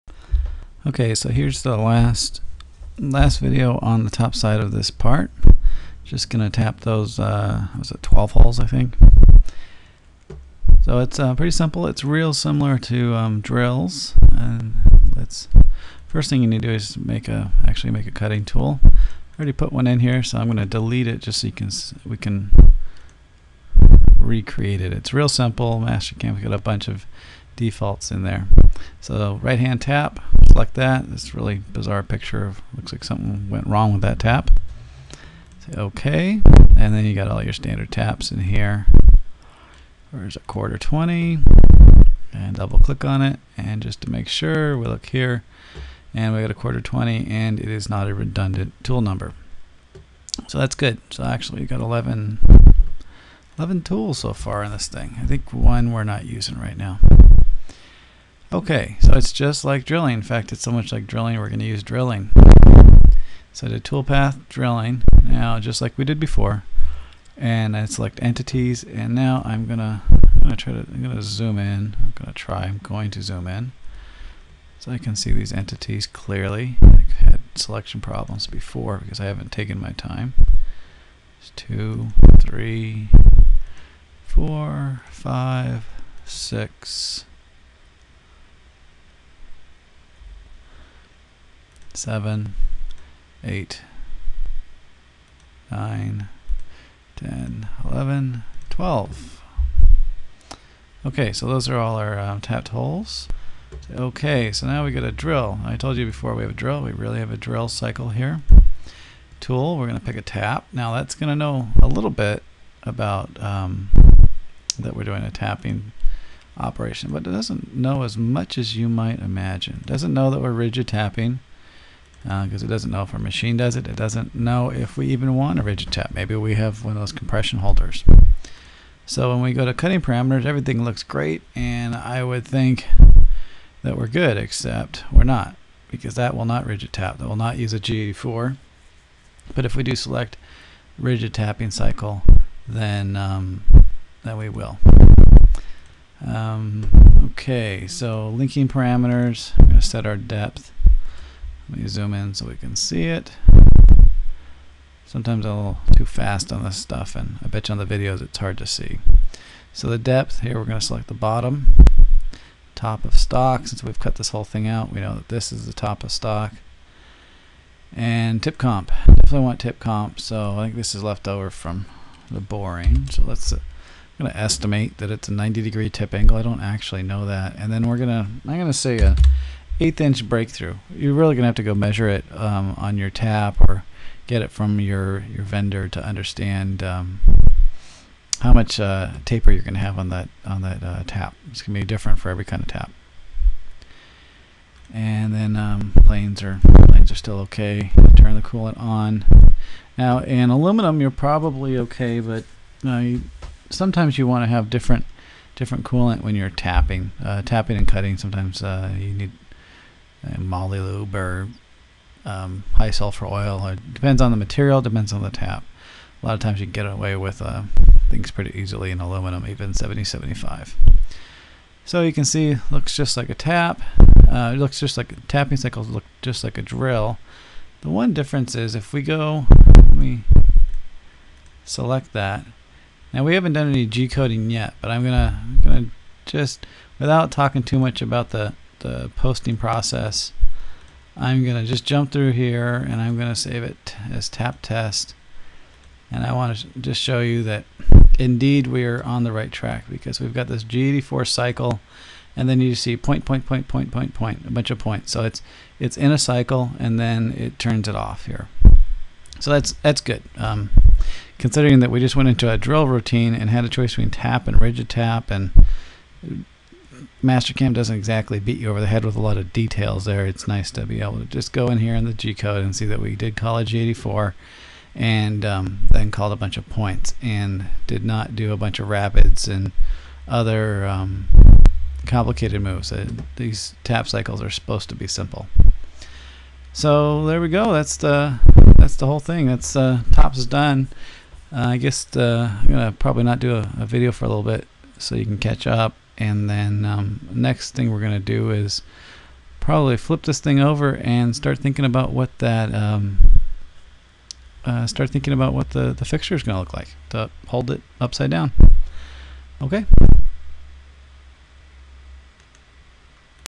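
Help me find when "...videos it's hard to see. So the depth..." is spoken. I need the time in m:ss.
2:37.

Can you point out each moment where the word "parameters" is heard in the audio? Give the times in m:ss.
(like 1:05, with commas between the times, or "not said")
2:10, 2:28.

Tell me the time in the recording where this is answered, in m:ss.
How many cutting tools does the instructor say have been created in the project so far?
0:53.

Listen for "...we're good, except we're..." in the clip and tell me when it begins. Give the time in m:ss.
2:13.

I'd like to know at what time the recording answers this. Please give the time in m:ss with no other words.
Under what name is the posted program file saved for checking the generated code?
4:04.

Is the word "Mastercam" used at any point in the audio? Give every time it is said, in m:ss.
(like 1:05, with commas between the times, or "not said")
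0:25, 4:27.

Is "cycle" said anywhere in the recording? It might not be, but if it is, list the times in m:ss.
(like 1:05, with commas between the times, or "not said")
1:47, 2:21, 3:45, 4:11, 4:16, 4:44.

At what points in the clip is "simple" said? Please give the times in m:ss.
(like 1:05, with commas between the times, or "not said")
0:11, 0:25, 4:45.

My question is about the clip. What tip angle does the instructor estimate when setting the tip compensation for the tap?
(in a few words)
90 degrees.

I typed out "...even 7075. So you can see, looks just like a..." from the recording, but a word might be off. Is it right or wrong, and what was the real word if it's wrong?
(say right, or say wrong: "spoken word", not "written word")
right.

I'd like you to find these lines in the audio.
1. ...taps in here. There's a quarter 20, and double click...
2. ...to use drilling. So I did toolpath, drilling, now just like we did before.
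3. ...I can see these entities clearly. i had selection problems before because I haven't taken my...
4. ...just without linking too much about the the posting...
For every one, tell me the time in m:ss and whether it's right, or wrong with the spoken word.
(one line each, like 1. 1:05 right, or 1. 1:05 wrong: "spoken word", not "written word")
1. 0:37 right
2. 1:01 right
3. 1:14 right
4. 3:56 wrong: "talking", not "linking".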